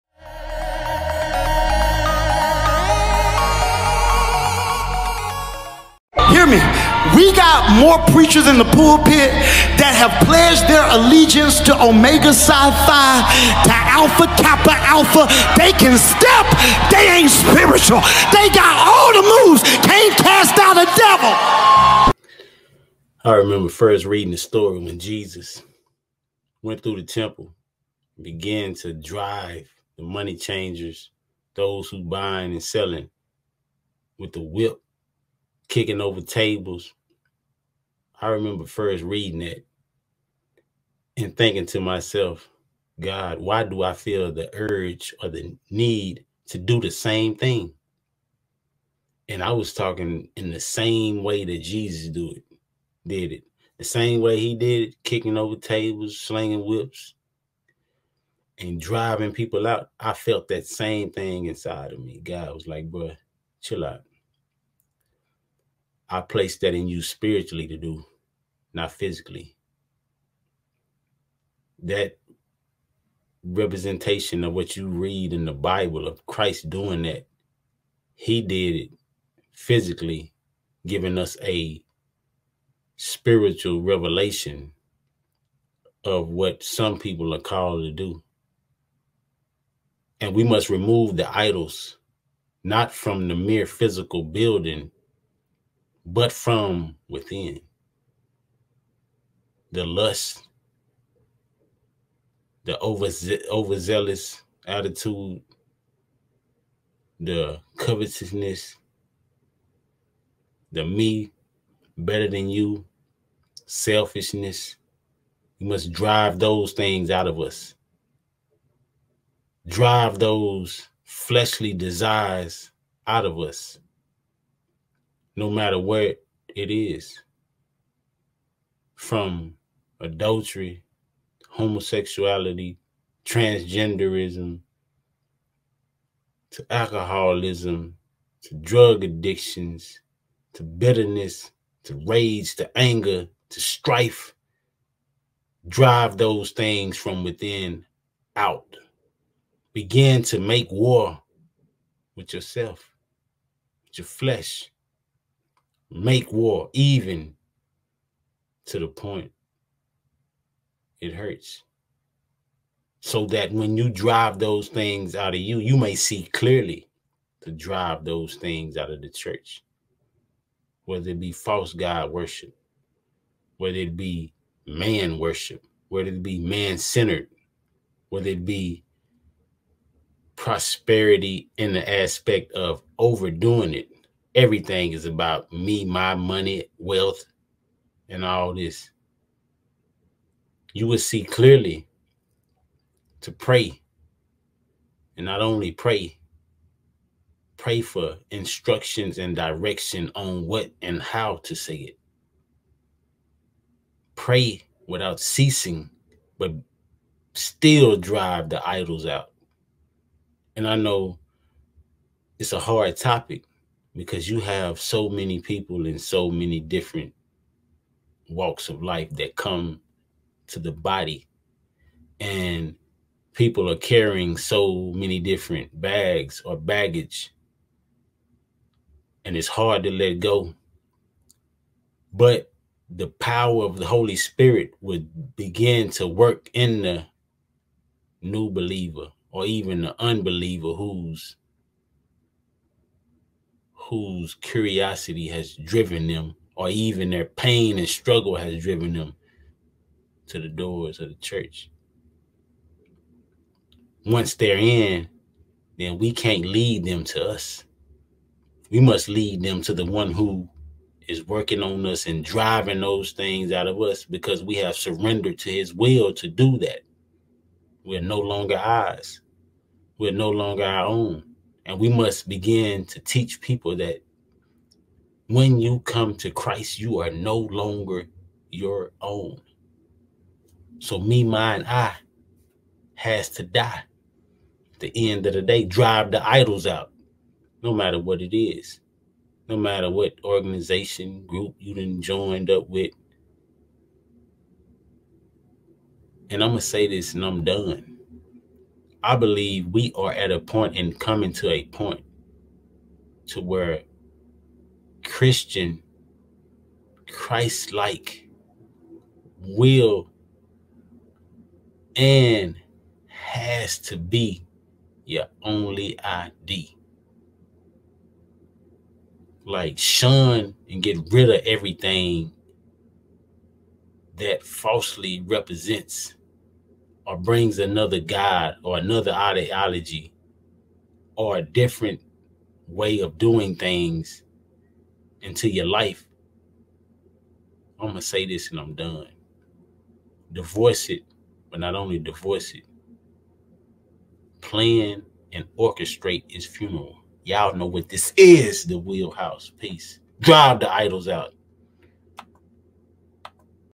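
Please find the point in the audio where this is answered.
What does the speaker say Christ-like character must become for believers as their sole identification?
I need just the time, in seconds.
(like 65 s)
315 s.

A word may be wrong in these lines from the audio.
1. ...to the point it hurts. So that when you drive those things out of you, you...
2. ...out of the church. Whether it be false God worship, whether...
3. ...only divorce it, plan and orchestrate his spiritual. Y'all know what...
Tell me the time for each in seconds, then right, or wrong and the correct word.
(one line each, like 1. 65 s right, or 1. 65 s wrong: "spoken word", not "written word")
1. 158 s right
2. 168 s right
3. 341 s wrong: "funeral", not "spiritual".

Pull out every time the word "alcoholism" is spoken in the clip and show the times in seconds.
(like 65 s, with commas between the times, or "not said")
136 s.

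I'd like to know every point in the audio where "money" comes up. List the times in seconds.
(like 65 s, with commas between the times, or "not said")
30 s, 186 s.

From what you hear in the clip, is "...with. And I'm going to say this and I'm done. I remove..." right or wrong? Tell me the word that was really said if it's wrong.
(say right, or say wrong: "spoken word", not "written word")
wrong: "believe", not "remove".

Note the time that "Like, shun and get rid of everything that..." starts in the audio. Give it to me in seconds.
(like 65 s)
319 s.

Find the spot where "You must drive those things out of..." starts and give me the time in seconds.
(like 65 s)
115 s.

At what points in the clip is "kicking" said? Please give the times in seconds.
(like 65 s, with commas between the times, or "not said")
35 s, 55 s.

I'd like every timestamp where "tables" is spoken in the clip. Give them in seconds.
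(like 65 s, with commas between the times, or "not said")
36 s, 55 s.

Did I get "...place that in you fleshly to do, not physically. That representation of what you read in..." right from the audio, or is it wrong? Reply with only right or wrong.
wrong.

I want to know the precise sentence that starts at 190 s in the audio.
You will see clearly to pray.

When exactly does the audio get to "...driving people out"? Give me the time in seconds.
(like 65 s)
58 s.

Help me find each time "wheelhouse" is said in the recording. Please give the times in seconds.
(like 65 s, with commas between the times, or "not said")
348 s.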